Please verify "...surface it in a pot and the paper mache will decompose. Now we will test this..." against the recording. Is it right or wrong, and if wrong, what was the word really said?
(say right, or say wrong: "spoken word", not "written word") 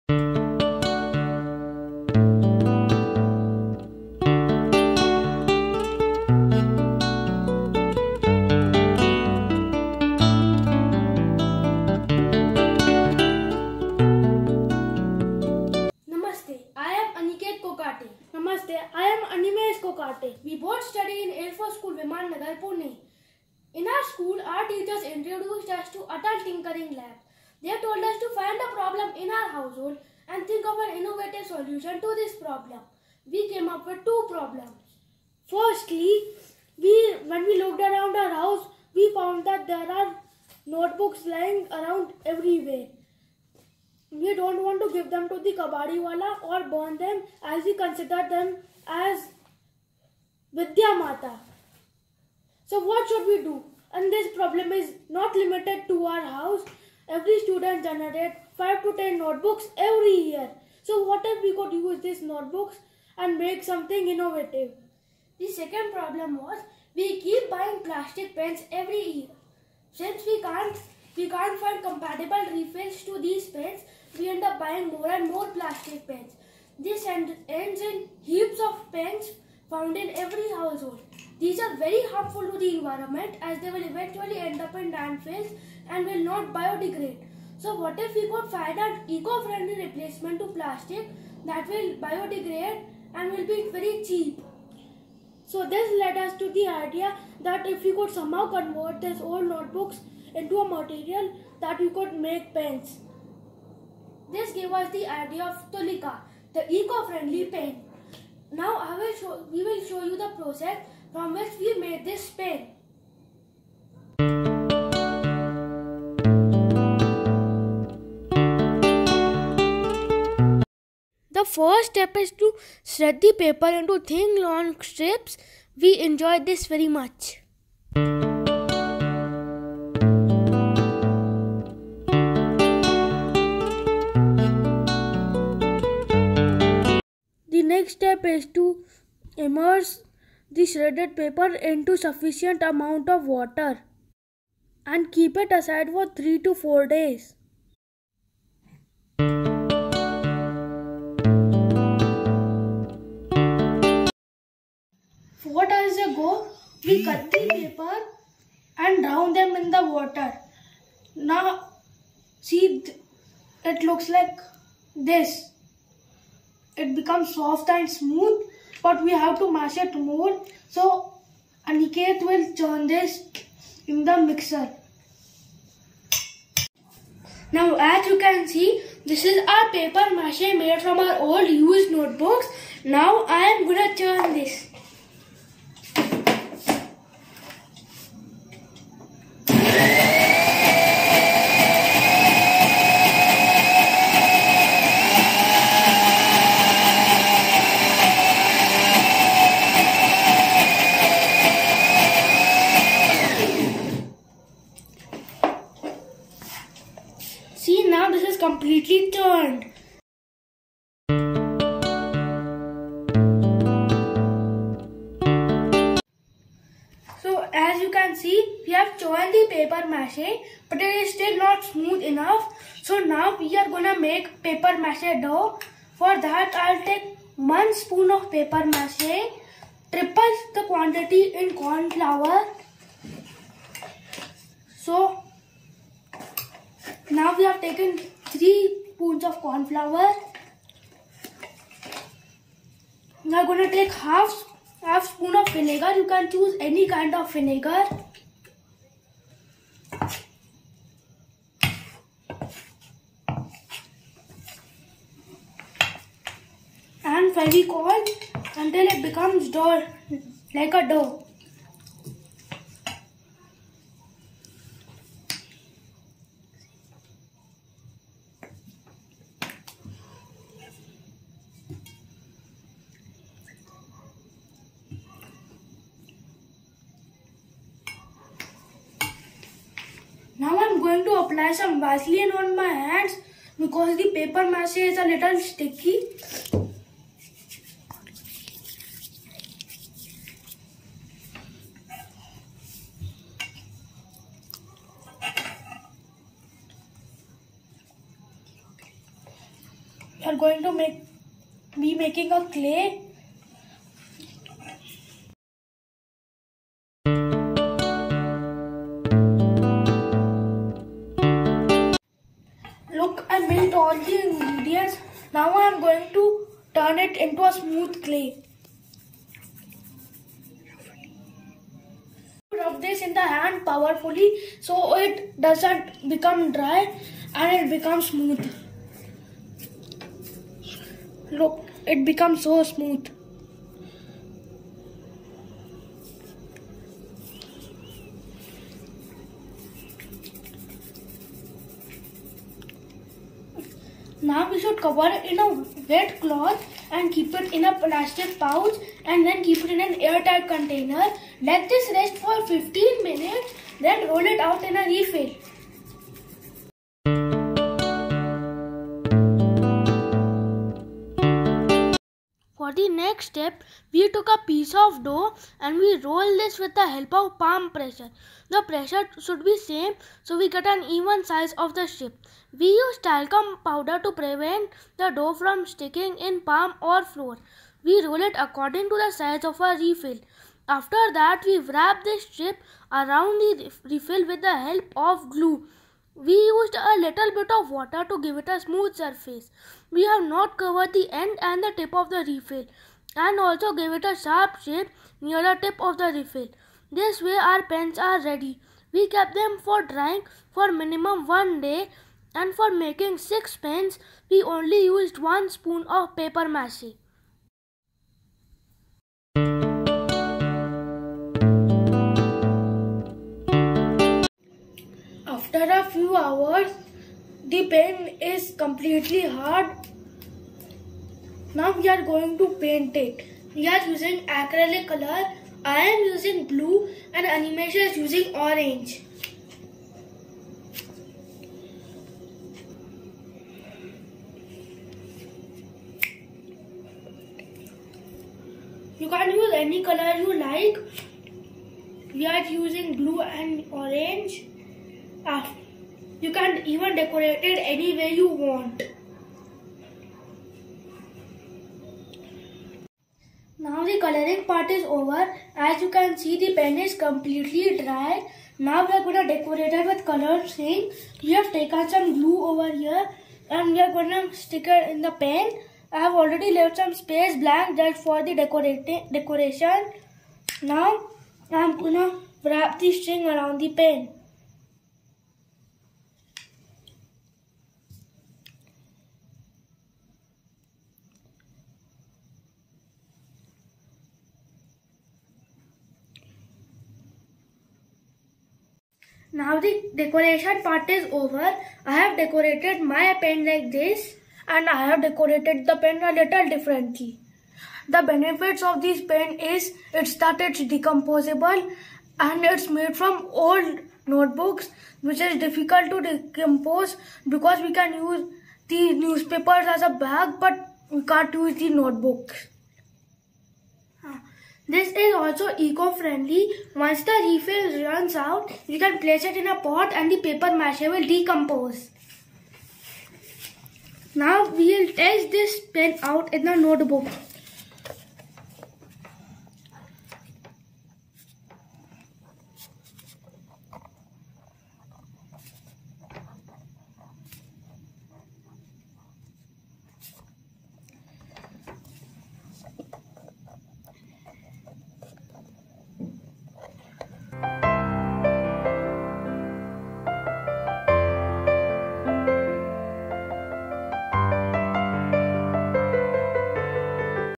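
wrong: "place", not "surface".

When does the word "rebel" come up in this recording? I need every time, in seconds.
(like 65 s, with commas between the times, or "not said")
not said.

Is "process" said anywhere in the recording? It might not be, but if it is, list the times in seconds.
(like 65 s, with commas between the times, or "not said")
110 s.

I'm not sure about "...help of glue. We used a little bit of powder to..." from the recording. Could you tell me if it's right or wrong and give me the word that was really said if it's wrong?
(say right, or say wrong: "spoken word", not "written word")
wrong: "water", not "powder".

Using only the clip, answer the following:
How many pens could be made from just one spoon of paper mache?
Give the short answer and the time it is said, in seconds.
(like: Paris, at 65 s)
6, at 403 s.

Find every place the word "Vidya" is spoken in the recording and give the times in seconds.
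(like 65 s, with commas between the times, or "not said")
50 s.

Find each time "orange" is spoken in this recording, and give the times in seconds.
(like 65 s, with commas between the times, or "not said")
428 s, 443 s.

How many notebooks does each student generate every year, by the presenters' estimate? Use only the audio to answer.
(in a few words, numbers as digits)
5 to 10.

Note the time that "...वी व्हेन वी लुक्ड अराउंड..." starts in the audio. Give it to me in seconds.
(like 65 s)
36 s.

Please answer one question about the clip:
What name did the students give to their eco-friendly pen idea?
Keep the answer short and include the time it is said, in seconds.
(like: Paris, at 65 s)
Tulika, at 105 s.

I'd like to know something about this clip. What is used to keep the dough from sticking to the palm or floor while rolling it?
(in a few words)
talcum powder.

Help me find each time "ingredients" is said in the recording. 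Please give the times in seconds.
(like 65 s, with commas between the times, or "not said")
314 s.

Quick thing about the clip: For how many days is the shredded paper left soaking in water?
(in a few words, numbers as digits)
3 to 4 days.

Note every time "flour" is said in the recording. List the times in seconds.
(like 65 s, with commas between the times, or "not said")
231 s, 239 s.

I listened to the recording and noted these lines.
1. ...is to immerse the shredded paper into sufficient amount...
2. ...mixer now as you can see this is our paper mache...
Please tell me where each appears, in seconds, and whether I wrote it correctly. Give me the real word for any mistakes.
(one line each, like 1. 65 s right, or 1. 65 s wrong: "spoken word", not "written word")
1. 138 s right
2. 174 s right.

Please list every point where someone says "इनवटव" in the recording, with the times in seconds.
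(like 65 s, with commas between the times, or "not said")
30 s.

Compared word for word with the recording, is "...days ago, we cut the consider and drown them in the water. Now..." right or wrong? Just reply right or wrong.
wrong.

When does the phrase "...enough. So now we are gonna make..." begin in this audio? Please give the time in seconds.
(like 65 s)
222 s.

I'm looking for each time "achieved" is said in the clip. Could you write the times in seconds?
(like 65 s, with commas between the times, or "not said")
not said.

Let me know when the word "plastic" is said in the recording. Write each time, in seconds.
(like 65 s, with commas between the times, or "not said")
67 s, 75 s, 90 s, 347 s.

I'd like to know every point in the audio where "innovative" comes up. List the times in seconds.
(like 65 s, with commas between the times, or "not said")
64 s.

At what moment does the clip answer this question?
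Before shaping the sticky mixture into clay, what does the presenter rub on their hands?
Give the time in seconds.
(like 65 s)
281 s.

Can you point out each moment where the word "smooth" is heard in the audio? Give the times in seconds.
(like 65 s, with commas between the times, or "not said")
167 s, 221 s, 317 s, 328 s, 332 s, 388 s.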